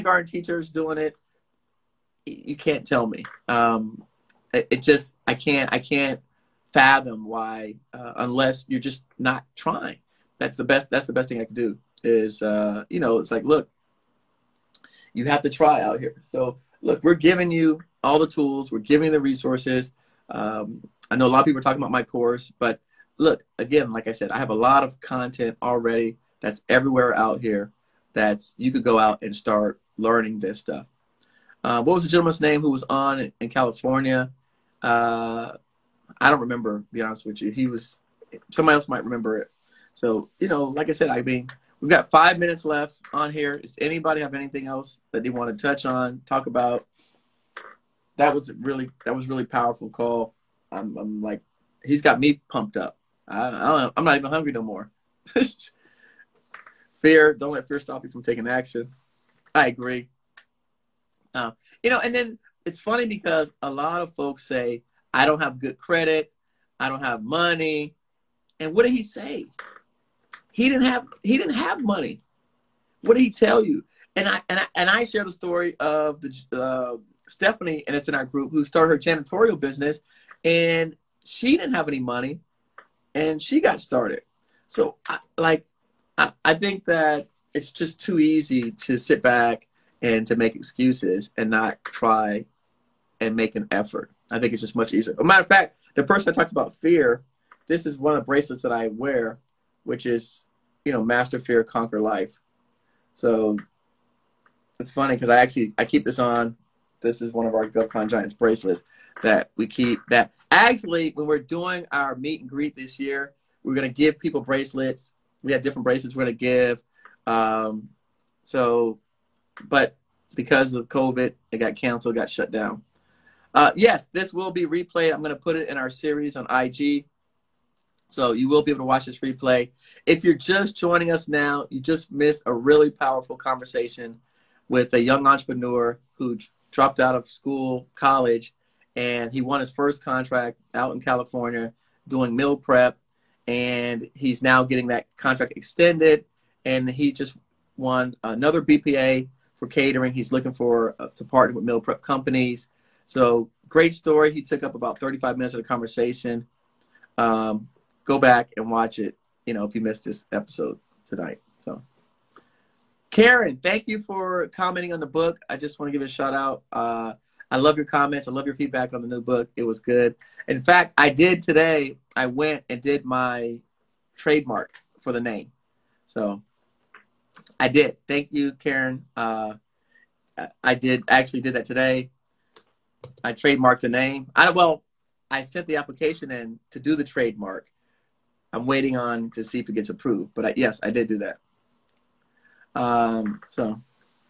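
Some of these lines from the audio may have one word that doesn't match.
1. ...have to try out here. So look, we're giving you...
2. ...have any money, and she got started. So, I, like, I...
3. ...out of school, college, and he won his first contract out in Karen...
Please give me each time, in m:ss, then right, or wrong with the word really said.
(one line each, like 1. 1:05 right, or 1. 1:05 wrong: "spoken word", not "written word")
1. 0:15 right
2. 1:21 right
3. 2:16 wrong: "California", not "Karen".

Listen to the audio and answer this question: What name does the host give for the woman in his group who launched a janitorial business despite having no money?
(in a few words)
Stephanie.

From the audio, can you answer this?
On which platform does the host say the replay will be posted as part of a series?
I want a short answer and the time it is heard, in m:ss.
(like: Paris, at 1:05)
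IG, at 2:06.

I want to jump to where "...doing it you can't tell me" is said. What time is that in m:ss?
0:00.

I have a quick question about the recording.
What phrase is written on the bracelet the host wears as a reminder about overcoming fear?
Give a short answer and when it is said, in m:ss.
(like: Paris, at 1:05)
master fear, conquer life, at 1:41.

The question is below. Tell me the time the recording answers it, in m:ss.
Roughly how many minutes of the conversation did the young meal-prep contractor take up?
2:34.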